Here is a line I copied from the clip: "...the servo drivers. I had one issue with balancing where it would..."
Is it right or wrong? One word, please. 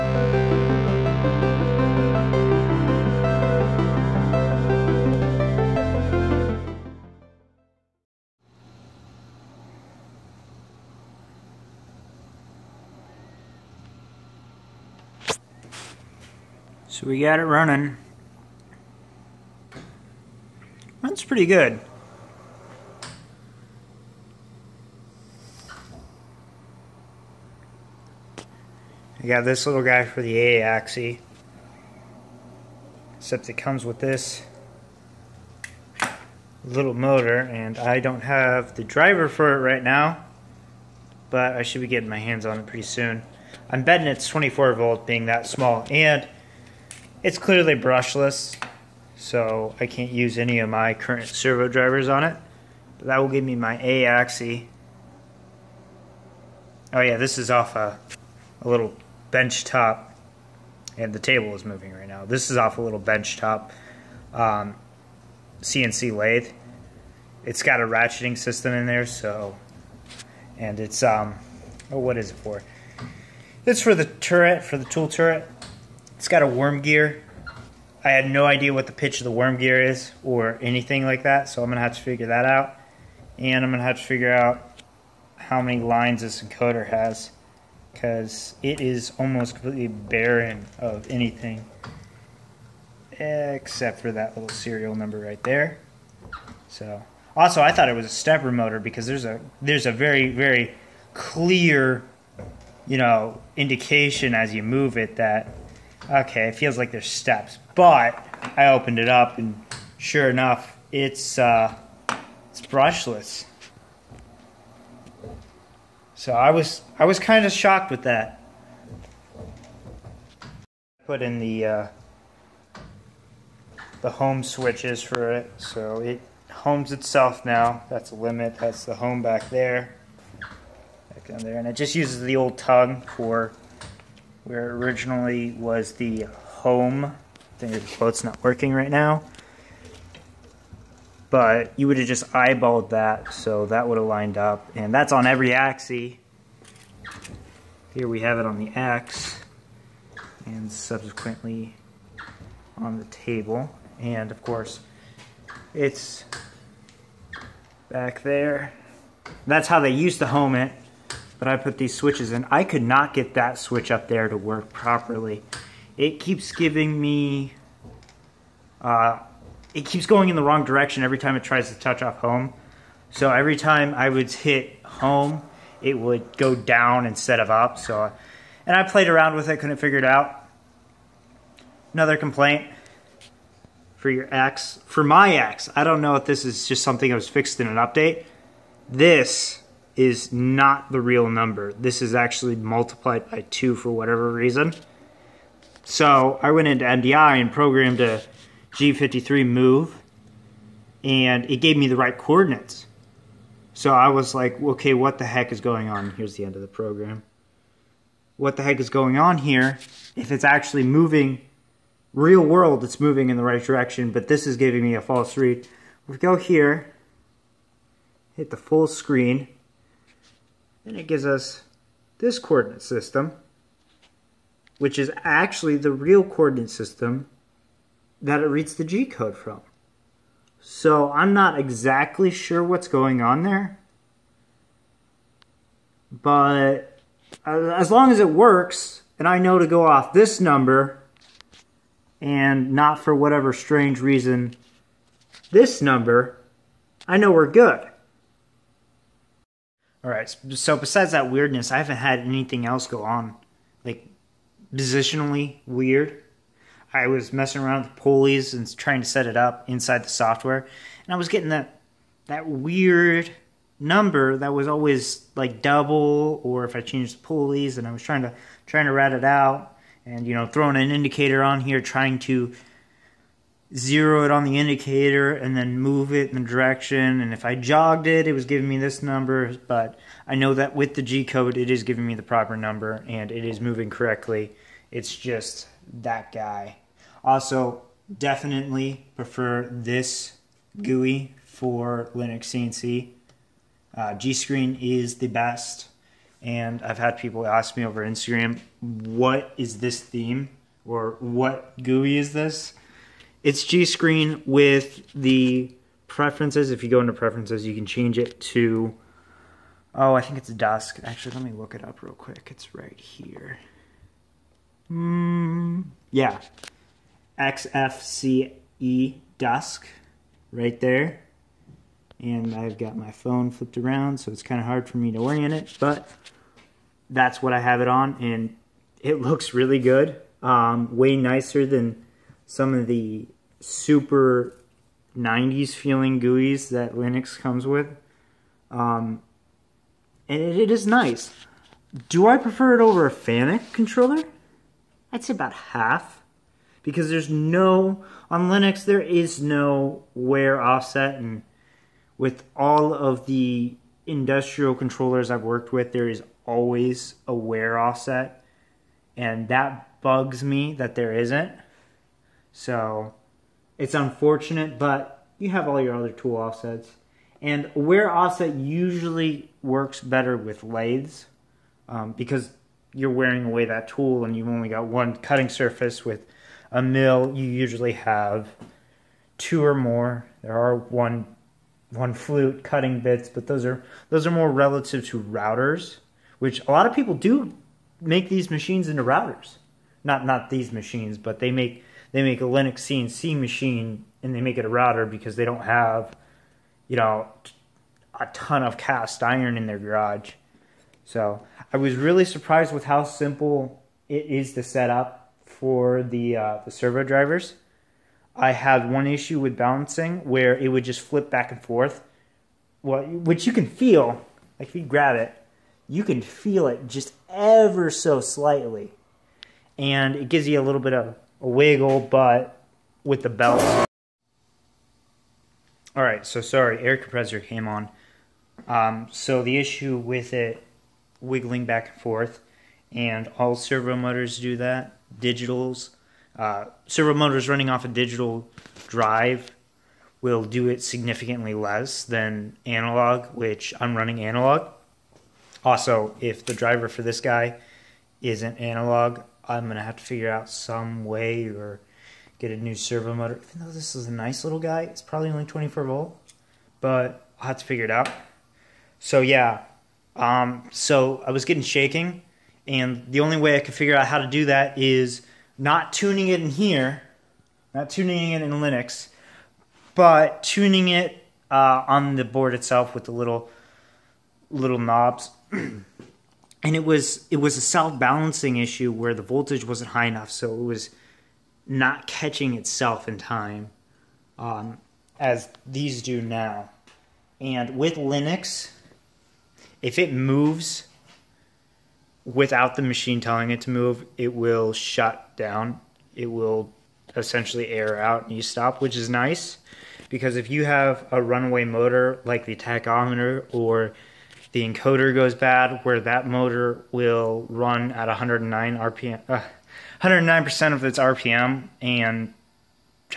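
right.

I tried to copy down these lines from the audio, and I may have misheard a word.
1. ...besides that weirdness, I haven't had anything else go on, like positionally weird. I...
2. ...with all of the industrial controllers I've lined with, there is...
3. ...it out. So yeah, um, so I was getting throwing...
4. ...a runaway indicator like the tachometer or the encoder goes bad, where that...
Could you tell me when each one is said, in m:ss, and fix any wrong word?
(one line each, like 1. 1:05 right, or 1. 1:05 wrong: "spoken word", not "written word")
1. 4:10 right
2. 5:52 wrong: "worked", not "lined"
3. 7:37 wrong: "shaking", not "throwing"
4. 8:21 wrong: "motor", not "indicator".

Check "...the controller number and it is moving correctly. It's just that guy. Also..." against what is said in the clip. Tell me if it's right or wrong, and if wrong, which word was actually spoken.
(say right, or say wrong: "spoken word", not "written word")
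wrong: "proper", not "controller".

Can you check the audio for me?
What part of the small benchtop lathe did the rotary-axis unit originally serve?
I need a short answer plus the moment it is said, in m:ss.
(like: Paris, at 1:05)
Tool turret, at 1:14.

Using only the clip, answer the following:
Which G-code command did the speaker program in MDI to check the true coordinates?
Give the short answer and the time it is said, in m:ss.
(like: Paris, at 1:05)
G53, at 3:18.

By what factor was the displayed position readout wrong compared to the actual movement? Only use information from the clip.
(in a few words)
2.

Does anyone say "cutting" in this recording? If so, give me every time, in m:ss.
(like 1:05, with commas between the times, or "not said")
6:15, 6:22.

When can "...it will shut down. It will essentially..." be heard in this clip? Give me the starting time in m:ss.
8:14.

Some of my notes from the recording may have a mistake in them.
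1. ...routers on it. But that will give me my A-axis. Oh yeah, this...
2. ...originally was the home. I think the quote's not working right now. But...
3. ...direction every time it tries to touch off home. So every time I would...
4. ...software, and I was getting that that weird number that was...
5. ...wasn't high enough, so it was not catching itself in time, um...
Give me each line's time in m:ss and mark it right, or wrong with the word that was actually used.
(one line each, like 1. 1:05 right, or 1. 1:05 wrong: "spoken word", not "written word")
1. 0:51 wrong: "drivers", not "routers"
2. 2:14 right
3. 2:50 right
4. 4:20 right
5. 7:59 right.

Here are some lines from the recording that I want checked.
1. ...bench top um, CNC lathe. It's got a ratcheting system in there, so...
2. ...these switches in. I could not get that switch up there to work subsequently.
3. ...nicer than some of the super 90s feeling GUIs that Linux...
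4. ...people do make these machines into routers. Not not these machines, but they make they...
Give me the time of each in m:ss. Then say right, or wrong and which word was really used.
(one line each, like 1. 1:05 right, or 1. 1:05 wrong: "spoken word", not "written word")
1. 1:02 right
2. 2:41 wrong: "properly", not "subsequently"
3. 5:31 right
4. 6:26 right.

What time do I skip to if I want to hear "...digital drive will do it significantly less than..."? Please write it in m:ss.
7:17.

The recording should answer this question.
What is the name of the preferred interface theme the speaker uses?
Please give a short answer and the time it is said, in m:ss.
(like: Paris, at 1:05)
XFCE dusk, at 5:17.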